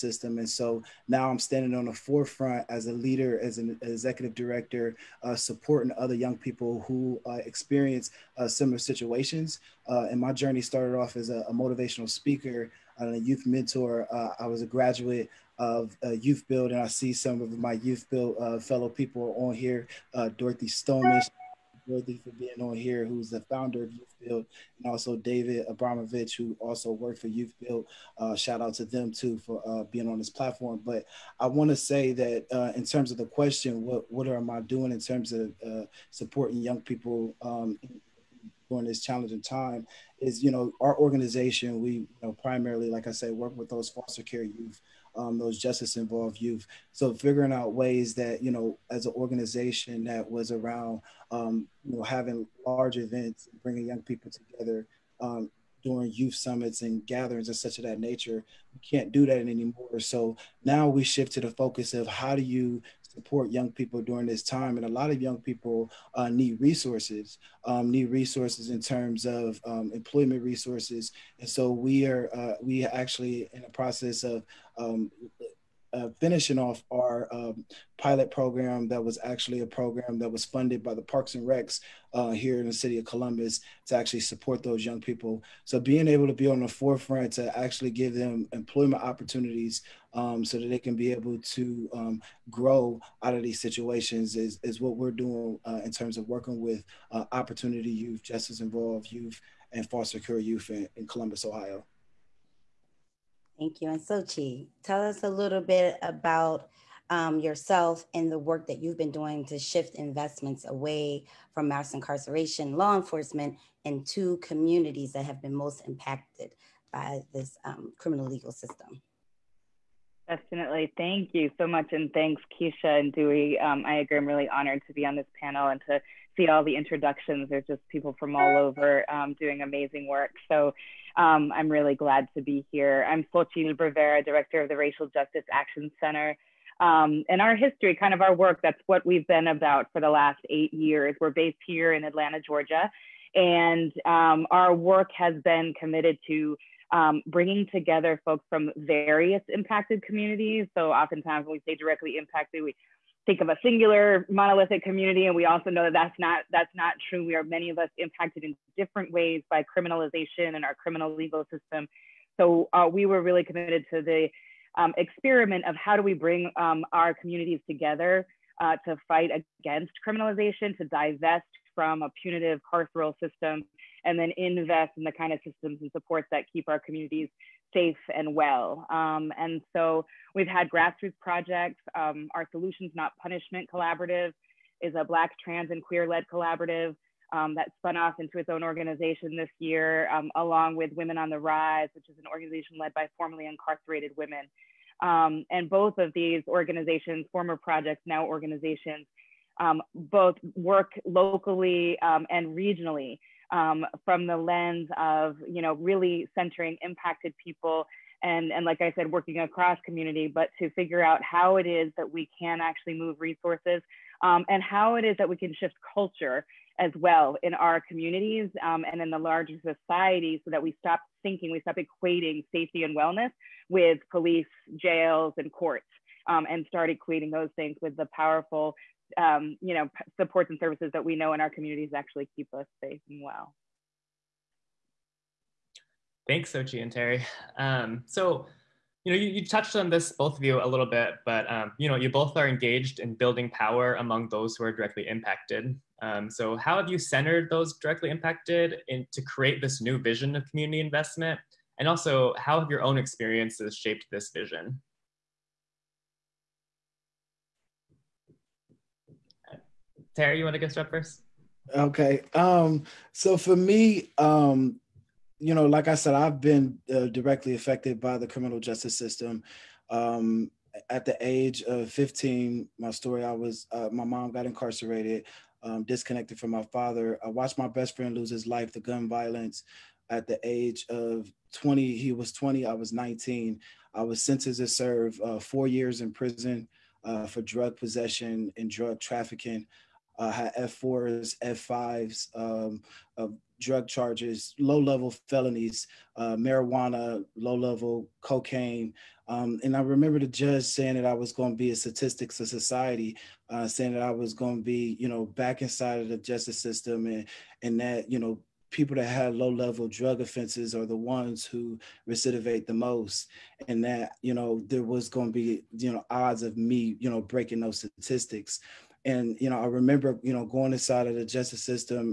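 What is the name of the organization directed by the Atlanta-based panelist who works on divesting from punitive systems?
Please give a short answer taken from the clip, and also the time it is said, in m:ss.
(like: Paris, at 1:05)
Racial Justice Action Center, at 2:14.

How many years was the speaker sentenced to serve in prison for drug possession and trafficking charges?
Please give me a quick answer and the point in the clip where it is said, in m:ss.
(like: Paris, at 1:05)
4, at 4:45.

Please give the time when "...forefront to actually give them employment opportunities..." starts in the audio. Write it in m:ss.
1:26.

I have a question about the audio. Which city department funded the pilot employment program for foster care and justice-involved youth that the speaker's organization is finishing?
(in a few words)
Parks and Recs.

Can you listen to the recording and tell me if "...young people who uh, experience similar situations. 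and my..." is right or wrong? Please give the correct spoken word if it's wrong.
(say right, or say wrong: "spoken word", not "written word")
right.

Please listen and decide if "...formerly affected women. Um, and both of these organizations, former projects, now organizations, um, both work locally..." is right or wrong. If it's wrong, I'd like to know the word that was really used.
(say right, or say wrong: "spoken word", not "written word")
wrong: "incarcerated", not "affected".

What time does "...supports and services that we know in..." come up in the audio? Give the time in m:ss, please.
3:50.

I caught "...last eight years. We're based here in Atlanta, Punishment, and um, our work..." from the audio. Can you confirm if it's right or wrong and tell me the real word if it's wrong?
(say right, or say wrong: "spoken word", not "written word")
wrong: "Georgia", not "Punishment".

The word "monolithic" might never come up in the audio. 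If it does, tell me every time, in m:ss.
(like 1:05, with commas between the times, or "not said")
2:34.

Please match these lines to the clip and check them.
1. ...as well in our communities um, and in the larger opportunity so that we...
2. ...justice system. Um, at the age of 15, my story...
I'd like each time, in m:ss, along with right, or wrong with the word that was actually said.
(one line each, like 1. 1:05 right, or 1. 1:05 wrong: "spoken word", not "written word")
1. 3:36 wrong: "society", not "opportunity"
2. 4:28 right.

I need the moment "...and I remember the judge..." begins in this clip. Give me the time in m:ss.
4:59.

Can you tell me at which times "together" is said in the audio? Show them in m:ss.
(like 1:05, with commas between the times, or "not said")
0:54, 2:27, 2:47.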